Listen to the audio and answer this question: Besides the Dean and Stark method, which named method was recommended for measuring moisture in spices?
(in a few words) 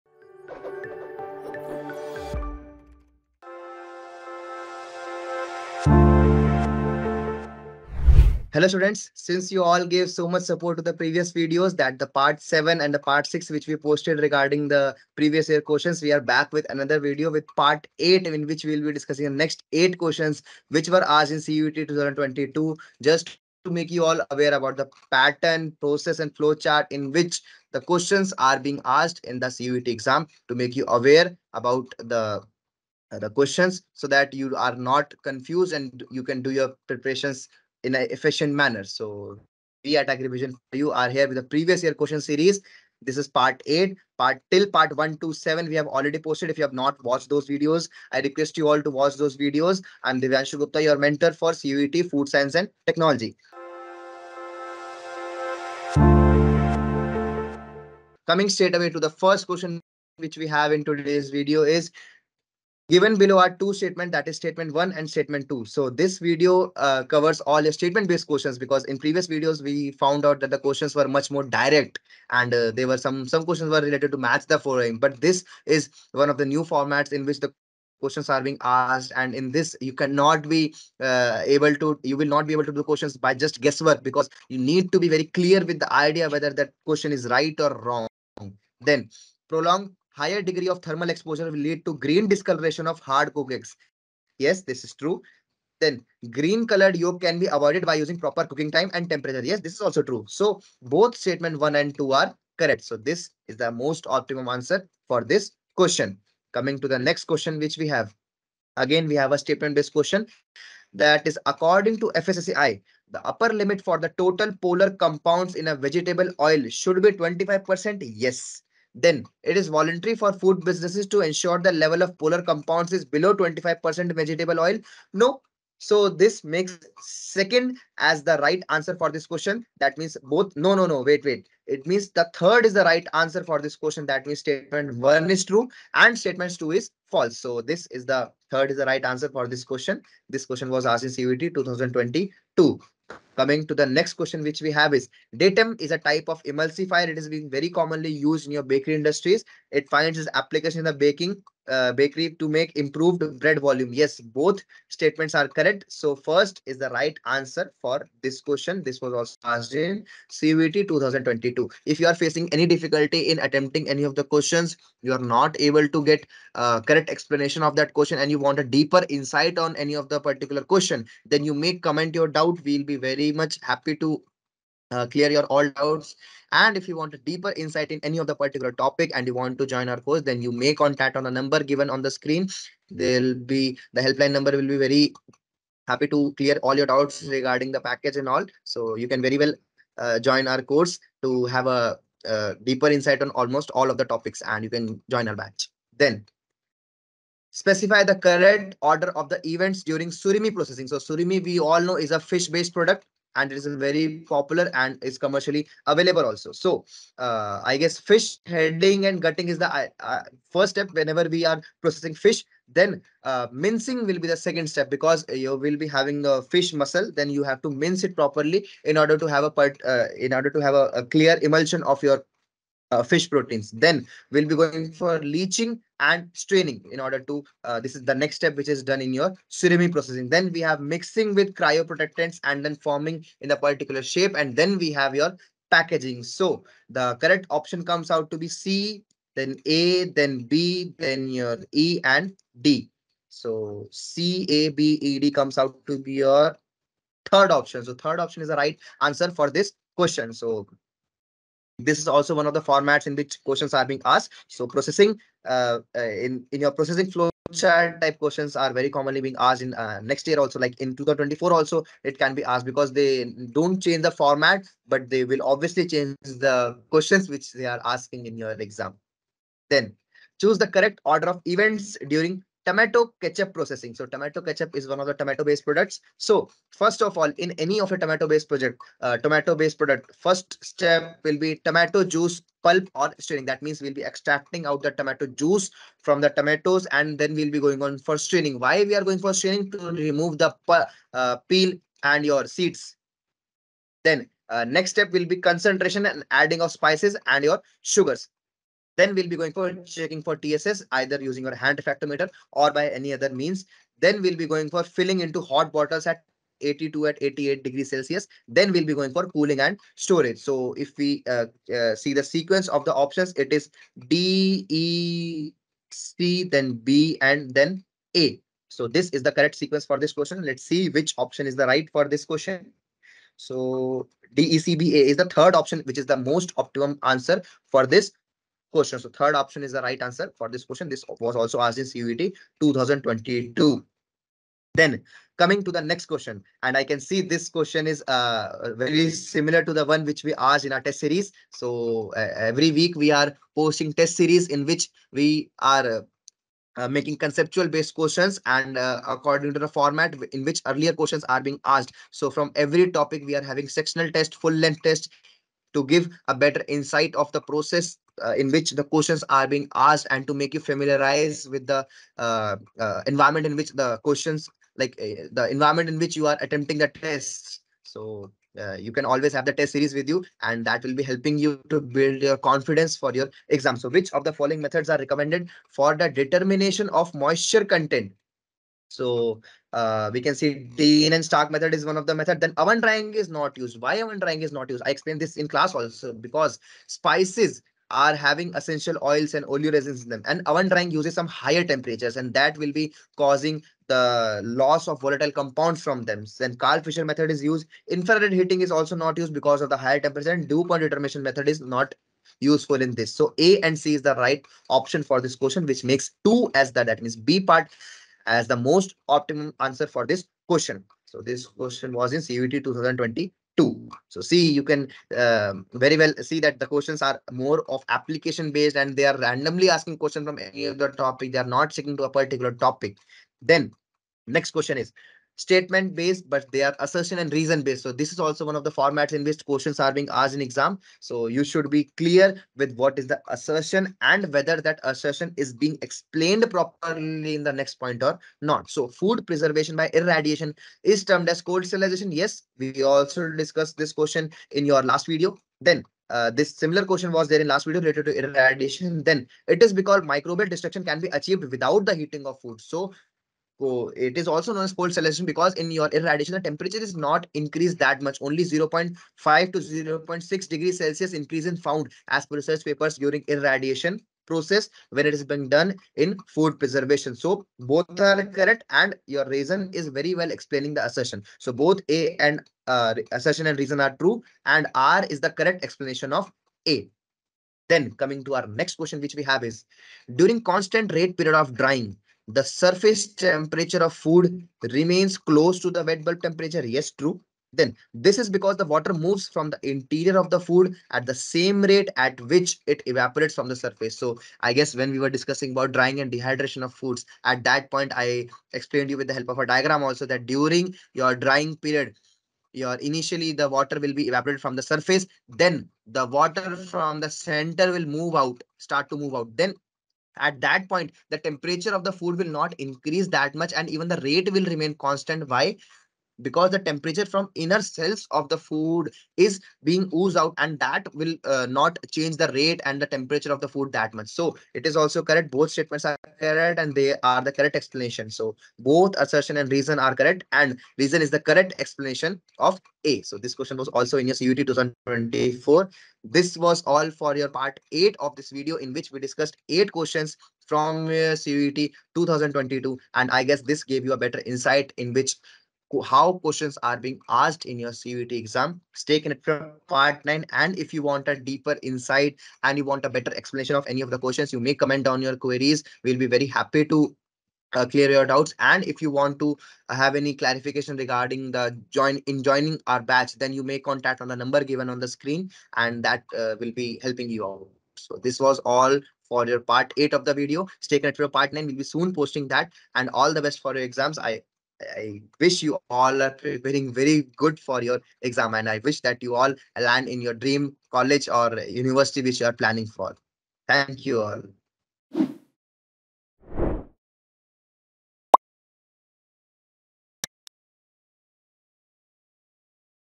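Karl Fischer method.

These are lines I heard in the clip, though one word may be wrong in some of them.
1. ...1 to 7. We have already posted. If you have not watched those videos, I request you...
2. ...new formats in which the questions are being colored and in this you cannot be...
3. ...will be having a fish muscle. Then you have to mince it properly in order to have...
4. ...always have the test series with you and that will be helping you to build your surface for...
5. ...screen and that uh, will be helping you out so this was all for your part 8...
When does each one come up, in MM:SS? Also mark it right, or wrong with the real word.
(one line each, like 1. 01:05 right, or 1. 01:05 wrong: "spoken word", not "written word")
1. 00:44 right
2. 01:16 wrong: "asked", not "colored"
3. 03:35 right
4. 06:09 wrong: "confidence", not "surface"
5. 09:24 right.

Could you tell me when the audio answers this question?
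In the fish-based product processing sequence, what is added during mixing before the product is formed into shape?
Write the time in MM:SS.
03:51.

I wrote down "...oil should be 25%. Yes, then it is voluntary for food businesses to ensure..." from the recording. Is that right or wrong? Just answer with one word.
right.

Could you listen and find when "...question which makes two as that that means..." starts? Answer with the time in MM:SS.
06:45.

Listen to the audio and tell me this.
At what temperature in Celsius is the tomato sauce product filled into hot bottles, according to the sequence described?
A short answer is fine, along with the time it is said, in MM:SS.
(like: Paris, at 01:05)
88, at 05:07.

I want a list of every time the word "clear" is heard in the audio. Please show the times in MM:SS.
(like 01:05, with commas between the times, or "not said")
01:25, 02:55, 03:06, 03:41, 07:11, 09:17.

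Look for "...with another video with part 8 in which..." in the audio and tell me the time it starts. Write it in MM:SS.
00:16.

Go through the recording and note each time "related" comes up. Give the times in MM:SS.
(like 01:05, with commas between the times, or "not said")
01:13, 07:27.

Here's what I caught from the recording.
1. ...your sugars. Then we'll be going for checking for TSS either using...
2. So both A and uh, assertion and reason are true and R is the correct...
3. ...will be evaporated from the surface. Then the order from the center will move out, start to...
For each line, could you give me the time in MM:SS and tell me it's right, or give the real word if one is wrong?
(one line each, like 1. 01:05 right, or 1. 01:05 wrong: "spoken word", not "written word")
1. 04:57 right
2. 07:51 right
3. 08:23 wrong: "water", not "order".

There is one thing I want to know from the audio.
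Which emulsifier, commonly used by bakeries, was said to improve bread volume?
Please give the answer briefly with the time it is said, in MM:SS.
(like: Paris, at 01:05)
DATEM, at 02:25.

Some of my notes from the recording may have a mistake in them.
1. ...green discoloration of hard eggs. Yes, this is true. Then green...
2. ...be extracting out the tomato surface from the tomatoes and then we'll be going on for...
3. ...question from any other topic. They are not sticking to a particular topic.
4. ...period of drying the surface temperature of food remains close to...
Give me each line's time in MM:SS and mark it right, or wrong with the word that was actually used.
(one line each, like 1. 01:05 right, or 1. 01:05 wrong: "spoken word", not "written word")
1. 01:31 right
2. 04:43 wrong: "juice", not "surface"
3. 06:59 right
4. 08:01 right.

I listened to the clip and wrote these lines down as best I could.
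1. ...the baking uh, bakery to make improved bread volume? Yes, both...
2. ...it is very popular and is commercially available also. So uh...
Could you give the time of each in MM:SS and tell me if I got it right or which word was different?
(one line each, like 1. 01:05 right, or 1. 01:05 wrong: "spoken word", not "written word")
1. 02:30 right
2. 03:23 right.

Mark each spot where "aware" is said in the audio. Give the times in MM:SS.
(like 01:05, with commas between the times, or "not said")
00:24, 00:30.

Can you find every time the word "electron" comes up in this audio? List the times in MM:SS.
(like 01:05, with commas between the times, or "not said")
not said.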